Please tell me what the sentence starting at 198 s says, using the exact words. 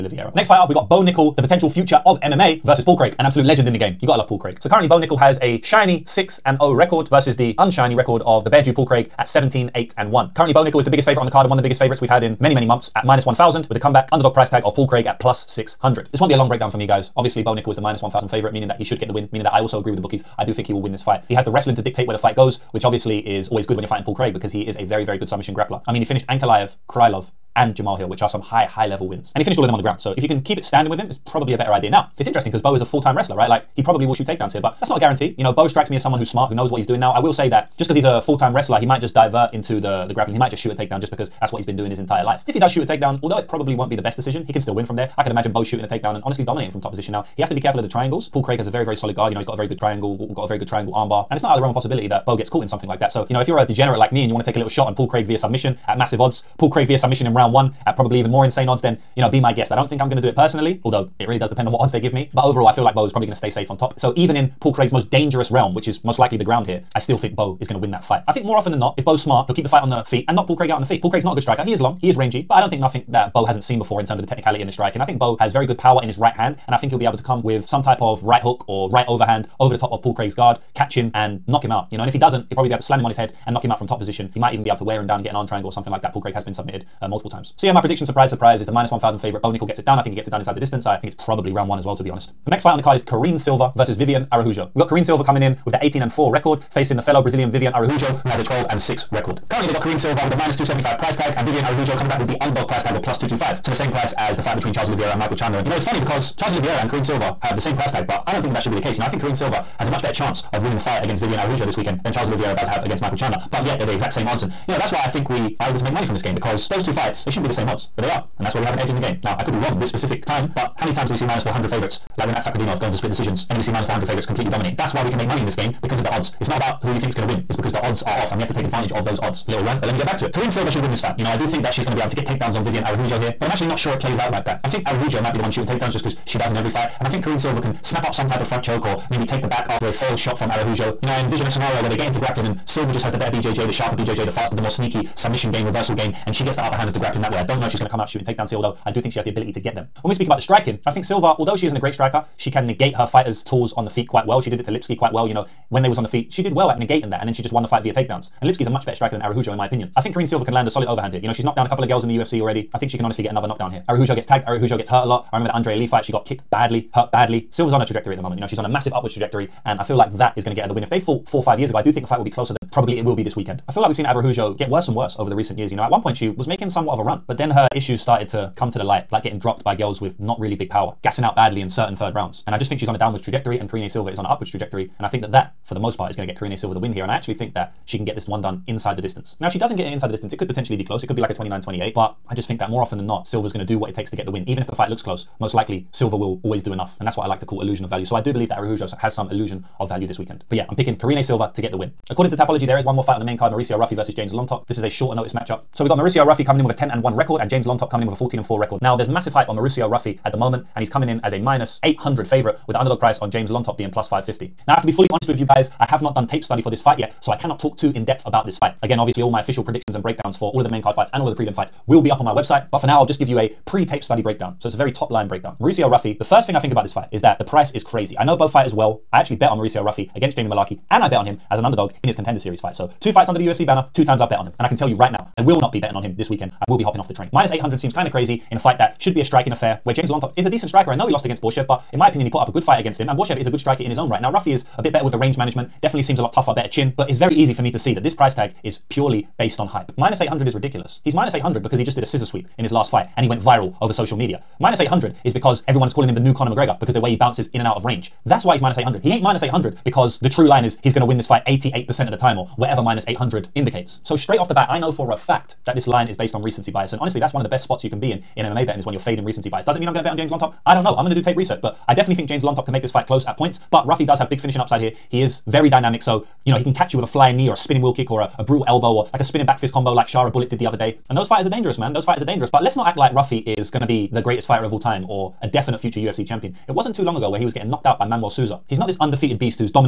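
So I do believe that Araujo has some illusion of value this weekend.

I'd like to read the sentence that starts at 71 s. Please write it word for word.
Paul Craig's not a good striker.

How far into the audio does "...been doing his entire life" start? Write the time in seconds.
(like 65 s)
41 s.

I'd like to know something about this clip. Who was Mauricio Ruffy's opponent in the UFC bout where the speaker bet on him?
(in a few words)
Jamie Mullarkey.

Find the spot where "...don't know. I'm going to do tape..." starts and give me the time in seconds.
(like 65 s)
270 s.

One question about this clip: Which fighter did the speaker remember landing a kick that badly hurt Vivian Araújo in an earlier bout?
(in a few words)
Andrea Lee.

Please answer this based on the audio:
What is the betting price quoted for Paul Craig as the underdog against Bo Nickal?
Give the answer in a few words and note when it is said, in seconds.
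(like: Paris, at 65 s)
+600, at 15 s.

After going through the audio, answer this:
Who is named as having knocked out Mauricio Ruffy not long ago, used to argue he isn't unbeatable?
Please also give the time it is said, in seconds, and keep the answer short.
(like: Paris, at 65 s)
Manuel Souza, at 288 s.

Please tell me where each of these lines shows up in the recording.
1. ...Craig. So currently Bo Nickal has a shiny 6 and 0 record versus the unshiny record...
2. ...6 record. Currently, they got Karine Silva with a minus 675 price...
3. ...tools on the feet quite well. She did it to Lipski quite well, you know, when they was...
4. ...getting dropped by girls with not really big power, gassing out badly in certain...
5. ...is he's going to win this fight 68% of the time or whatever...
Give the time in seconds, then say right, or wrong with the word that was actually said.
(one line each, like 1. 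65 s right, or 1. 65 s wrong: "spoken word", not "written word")
1. 4 s right
2. 98 s wrong: "275", not "675"
3. 153 s right
4. 179 s right
5. 260 s wrong: "88", not "68".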